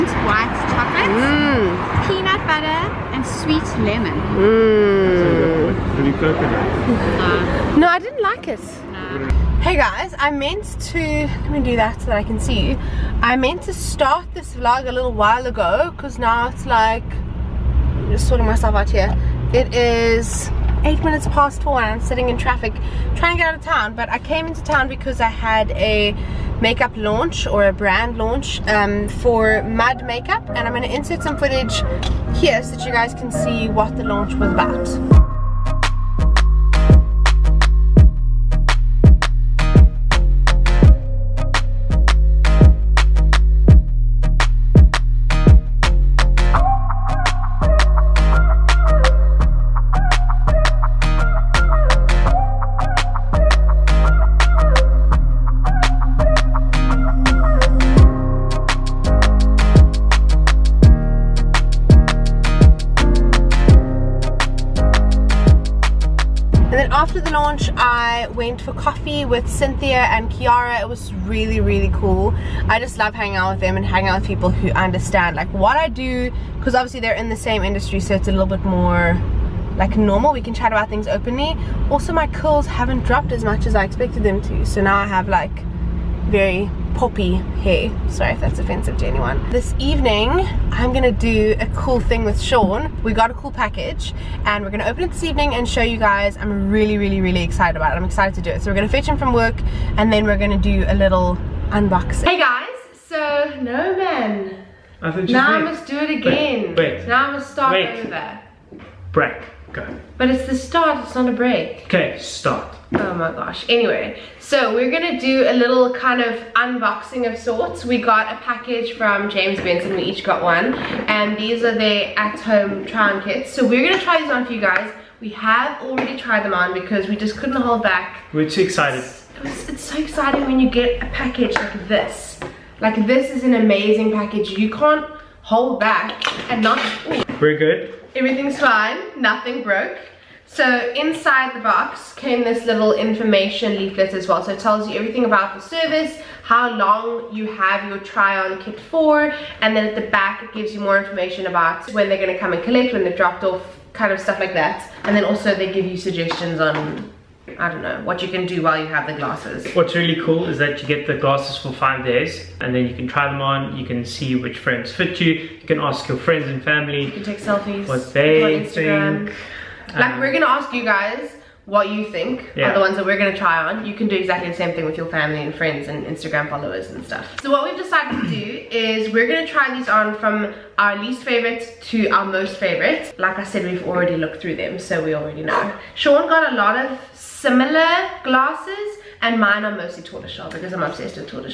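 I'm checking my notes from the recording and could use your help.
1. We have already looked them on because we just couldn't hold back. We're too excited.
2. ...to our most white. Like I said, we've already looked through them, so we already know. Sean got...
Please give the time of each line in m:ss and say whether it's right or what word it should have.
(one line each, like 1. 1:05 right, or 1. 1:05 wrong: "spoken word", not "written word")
1. 2:05 wrong: "tried", not "looked"
2. 3:01 wrong: "favorite", not "white".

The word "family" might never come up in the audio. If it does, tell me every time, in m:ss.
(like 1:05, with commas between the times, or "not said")
2:46, 2:55.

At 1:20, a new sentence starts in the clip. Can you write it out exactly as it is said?
We can chat about things openly.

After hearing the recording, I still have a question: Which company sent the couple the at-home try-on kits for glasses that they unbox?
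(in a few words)
James Bensen.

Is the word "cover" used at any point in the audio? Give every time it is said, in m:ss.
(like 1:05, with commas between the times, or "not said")
not said.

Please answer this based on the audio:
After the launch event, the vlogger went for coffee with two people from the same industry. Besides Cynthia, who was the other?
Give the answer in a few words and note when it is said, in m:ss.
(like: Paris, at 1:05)
Kiara, at 1:10.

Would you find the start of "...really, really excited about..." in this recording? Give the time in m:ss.
1:36.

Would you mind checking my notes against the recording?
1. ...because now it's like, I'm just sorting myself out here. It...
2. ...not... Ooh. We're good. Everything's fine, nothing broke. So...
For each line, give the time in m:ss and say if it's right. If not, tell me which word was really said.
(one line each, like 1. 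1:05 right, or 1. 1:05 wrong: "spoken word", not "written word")
1. 0:15 right
2. 2:16 right.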